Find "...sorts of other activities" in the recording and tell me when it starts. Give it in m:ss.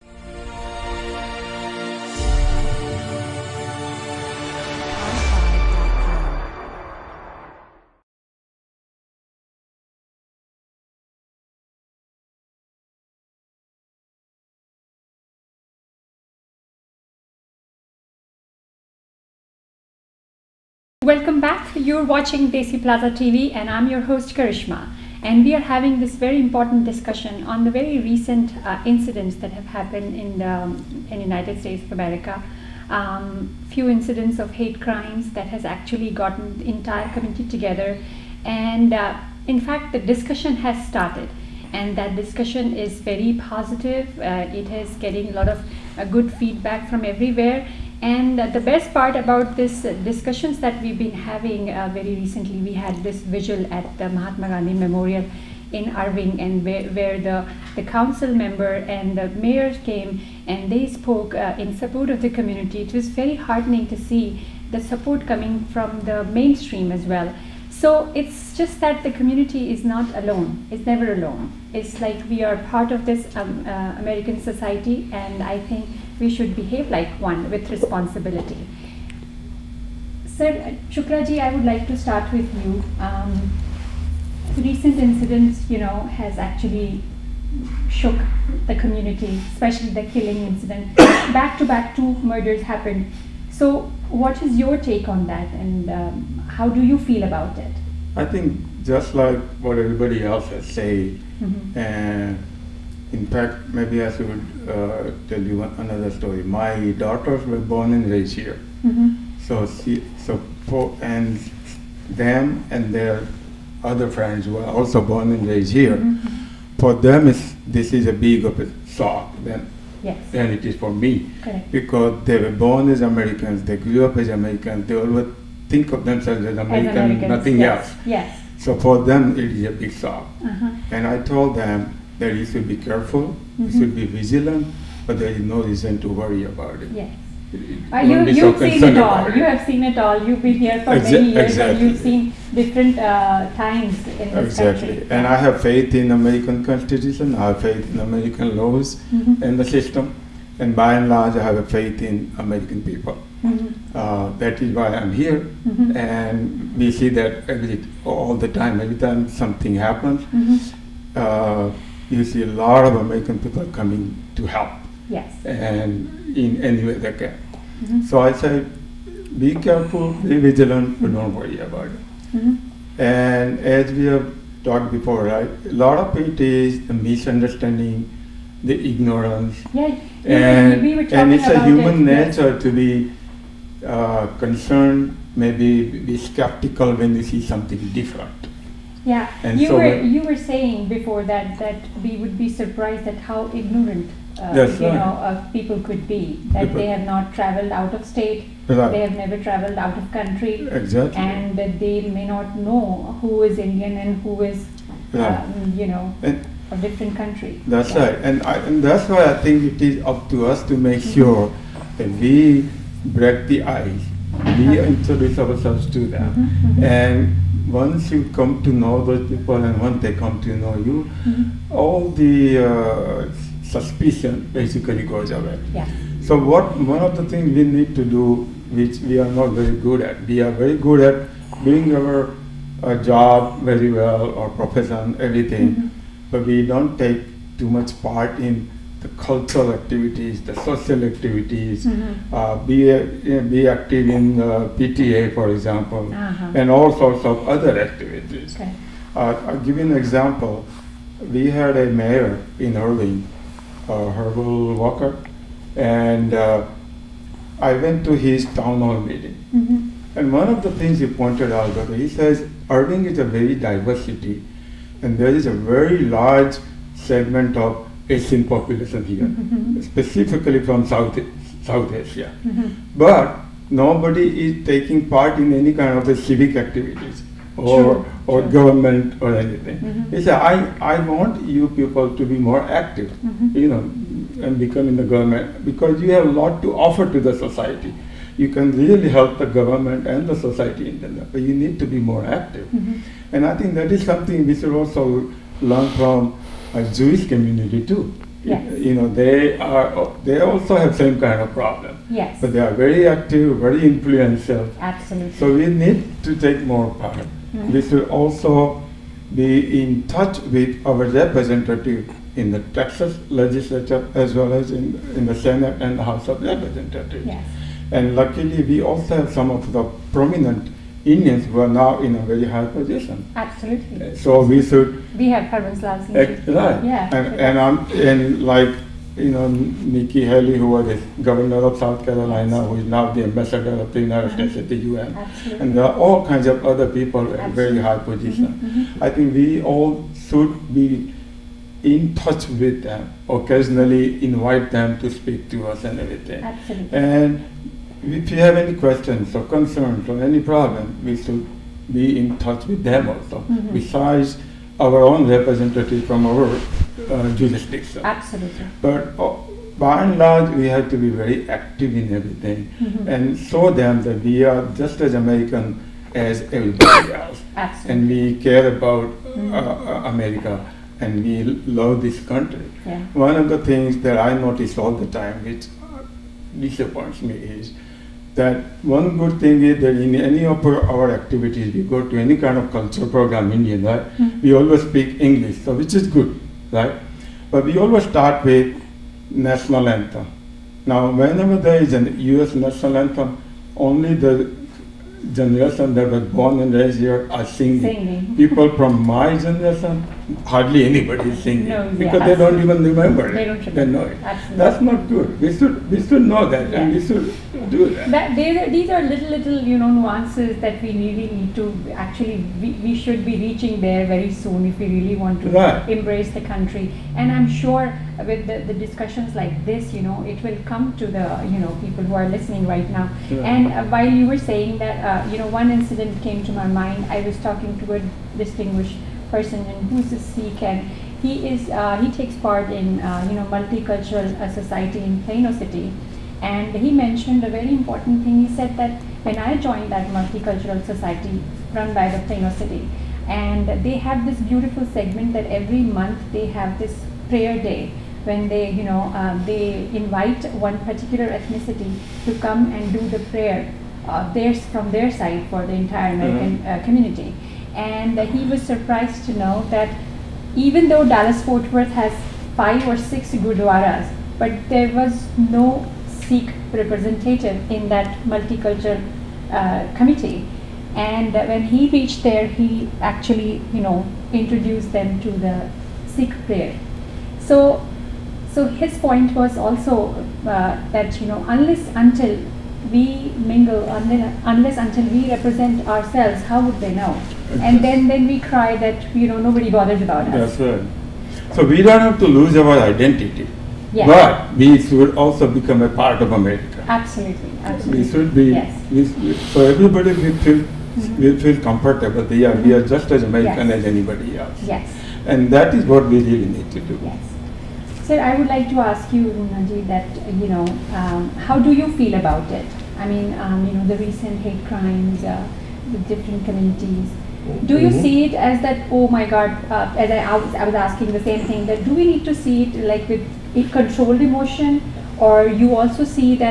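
4:06.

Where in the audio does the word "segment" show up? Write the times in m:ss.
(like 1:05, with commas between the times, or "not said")
4:26, 7:24.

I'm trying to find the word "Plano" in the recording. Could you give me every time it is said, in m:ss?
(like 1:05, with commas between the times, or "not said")
7:15, 7:22.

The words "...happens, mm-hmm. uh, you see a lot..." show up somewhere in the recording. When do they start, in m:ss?
2:39.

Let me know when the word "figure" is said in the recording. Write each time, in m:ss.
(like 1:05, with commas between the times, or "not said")
not said.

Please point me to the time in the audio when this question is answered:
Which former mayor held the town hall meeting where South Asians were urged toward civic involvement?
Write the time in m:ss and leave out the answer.
4:14.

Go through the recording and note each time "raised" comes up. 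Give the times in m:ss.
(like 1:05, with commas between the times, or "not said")
1:48, 1:55, 6:36.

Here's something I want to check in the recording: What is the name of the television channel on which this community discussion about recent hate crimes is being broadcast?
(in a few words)
Desi Plaza TV.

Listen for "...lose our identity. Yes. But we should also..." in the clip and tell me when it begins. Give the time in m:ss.
8:12.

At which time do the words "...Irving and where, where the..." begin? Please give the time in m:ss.
0:55.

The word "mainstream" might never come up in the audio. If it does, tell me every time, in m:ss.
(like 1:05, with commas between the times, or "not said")
1:06.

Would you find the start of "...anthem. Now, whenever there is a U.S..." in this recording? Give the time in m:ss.
6:29.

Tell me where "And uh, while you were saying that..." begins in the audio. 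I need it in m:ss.
7:03.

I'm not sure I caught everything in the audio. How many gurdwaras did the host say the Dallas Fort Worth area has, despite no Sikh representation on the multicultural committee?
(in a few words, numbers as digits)
5 or 6.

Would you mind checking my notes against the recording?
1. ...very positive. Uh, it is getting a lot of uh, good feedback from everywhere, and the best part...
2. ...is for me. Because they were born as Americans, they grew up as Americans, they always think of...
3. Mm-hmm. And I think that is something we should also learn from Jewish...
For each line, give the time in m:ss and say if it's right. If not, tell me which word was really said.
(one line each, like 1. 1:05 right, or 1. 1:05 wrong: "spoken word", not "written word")
1. 0:42 right
2. 2:00 right
3. 4:52 right.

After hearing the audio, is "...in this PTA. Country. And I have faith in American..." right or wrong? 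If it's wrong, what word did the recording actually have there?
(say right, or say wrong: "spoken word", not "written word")
wrong: "Exactly", not "PTA".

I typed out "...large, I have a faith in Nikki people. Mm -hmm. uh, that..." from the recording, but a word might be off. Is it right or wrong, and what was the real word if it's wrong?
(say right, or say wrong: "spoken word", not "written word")
wrong: "American", not "Nikki".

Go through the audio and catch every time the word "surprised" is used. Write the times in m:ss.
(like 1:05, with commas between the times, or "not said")
3:12, 7:38.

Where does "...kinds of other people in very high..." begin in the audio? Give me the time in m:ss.
5:36.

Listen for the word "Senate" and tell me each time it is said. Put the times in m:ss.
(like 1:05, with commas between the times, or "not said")
5:15.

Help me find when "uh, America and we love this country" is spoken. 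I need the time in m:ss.
6:09.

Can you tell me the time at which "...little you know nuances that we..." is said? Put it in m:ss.
6:49.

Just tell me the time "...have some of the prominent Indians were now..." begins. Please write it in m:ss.
5:19.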